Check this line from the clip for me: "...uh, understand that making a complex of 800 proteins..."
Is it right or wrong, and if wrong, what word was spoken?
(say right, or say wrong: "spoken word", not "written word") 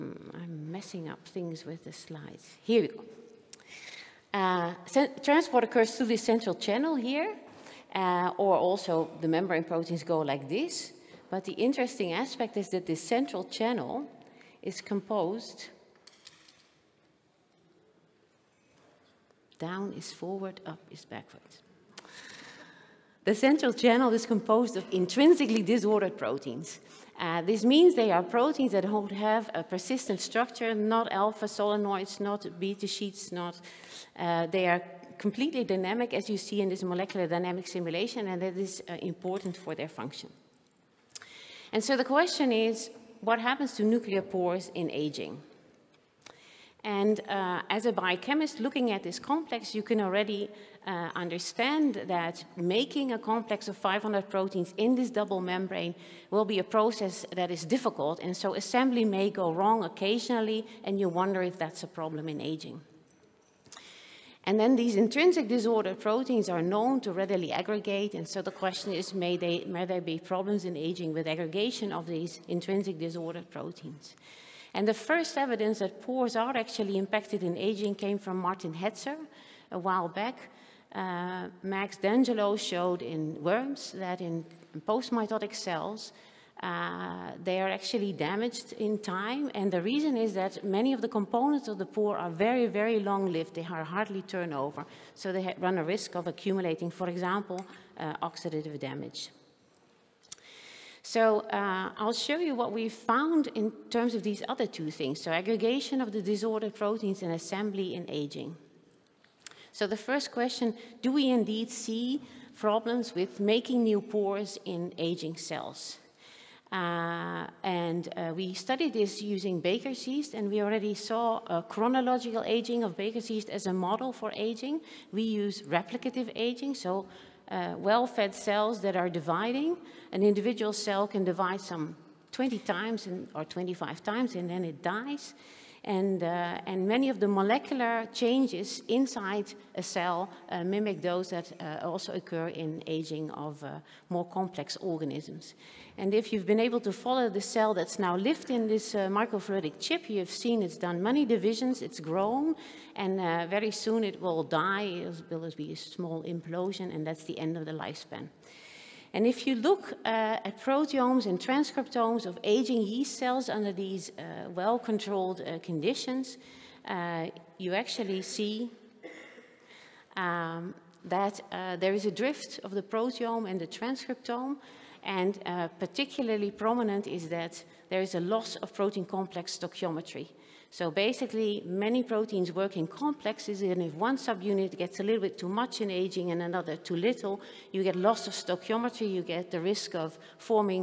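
wrong: "500", not "800".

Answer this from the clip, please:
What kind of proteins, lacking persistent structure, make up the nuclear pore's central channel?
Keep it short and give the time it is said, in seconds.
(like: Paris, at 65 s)
Intrinsically disordered proteins, at 24 s.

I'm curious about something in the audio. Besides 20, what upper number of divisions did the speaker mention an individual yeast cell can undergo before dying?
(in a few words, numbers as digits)
25.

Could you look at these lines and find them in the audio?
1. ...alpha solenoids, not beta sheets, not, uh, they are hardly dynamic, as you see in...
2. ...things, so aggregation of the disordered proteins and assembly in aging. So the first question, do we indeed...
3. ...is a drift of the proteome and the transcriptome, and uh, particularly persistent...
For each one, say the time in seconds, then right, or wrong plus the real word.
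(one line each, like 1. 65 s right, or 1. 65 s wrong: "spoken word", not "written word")
1. 31 s wrong: "completely", not "hardly"
2. 104 s right
3. 171 s wrong: "prominent", not "persistent".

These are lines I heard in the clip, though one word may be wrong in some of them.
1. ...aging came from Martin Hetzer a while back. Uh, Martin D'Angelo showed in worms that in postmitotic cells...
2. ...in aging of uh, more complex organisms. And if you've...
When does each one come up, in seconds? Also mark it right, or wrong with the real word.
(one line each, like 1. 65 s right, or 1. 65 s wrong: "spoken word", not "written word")
1. 77 s wrong: "Max", not "Martin"
2. 142 s right.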